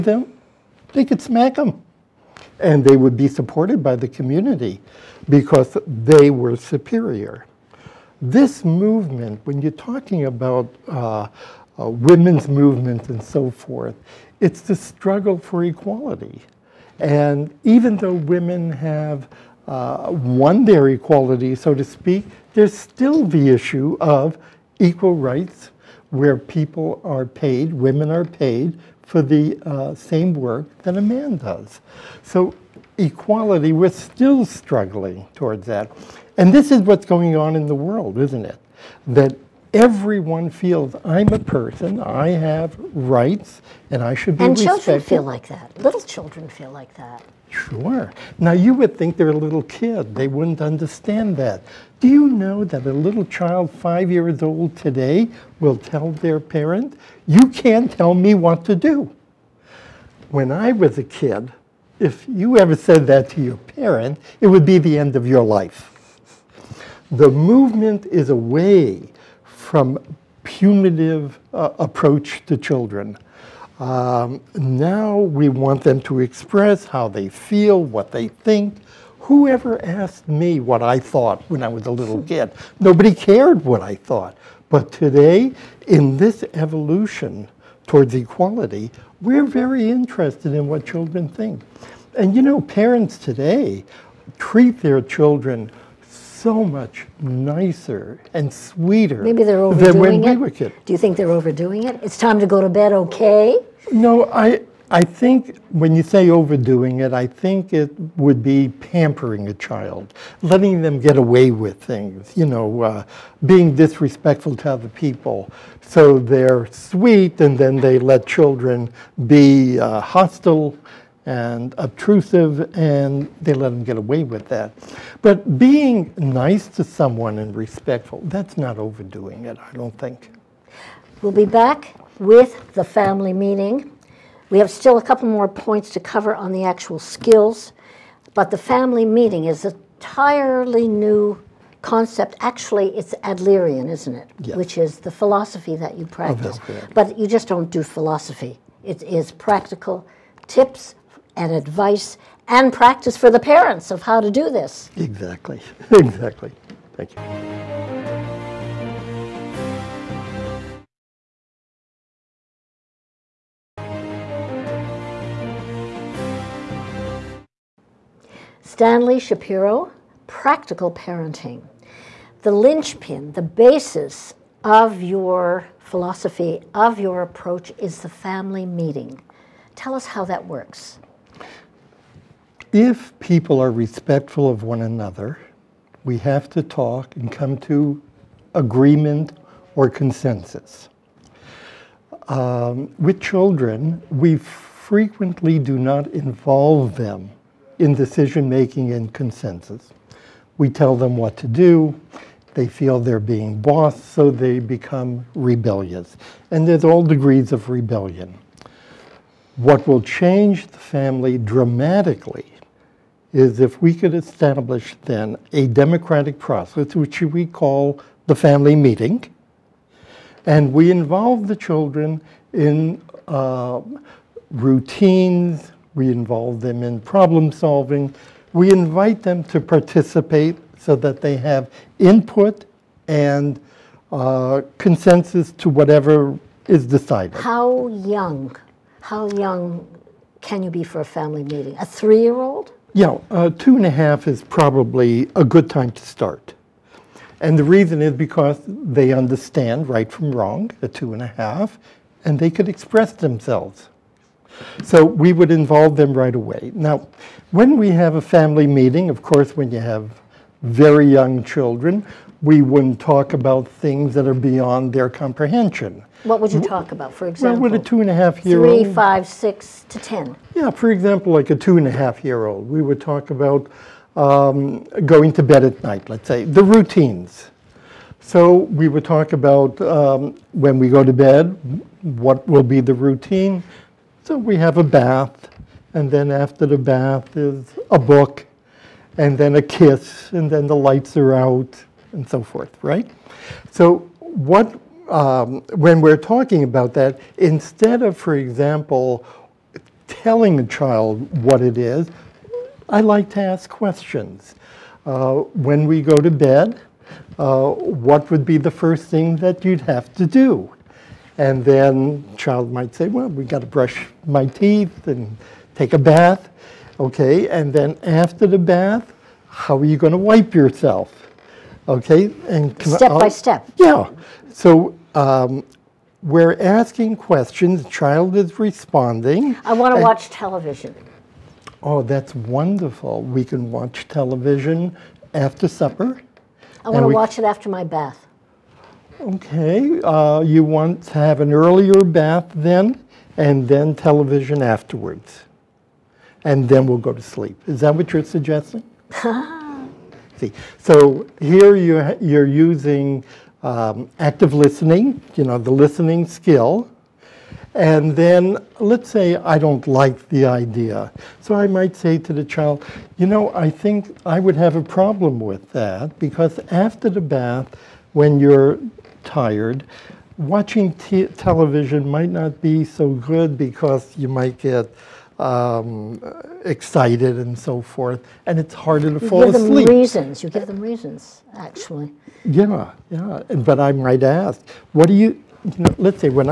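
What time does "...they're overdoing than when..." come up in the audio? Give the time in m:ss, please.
1:39.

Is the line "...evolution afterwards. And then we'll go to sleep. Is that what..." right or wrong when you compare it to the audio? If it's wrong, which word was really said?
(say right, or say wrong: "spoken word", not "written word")
wrong: "television", not "evolution".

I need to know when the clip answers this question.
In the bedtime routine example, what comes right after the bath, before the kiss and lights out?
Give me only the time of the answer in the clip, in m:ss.
4:47.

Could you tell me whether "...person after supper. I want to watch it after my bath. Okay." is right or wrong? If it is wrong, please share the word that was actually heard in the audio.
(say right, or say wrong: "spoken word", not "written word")
wrong: "television", not "person".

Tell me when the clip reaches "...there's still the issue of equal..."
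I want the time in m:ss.
0:22.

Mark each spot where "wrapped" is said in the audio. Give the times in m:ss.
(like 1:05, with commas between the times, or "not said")
not said.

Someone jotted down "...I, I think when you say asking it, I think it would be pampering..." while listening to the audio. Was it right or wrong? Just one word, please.
wrong.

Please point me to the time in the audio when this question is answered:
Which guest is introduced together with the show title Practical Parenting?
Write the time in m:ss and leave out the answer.
2:48.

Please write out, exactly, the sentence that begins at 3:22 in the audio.
They feel they're being bossed, so they become rebellious.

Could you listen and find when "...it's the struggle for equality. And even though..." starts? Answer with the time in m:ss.
0:14.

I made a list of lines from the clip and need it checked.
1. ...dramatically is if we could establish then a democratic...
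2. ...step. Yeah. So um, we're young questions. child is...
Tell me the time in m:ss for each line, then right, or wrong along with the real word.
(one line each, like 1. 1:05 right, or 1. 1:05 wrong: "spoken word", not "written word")
1. 3:31 right
2. 5:23 wrong: "asking", not "young".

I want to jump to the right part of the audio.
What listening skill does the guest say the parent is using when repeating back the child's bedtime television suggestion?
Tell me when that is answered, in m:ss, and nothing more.
5:54.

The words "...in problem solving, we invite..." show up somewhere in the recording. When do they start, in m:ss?
3:46.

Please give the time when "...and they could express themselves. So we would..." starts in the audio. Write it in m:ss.
4:12.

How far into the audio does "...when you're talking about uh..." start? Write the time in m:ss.
0:09.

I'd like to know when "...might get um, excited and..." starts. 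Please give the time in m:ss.
6:14.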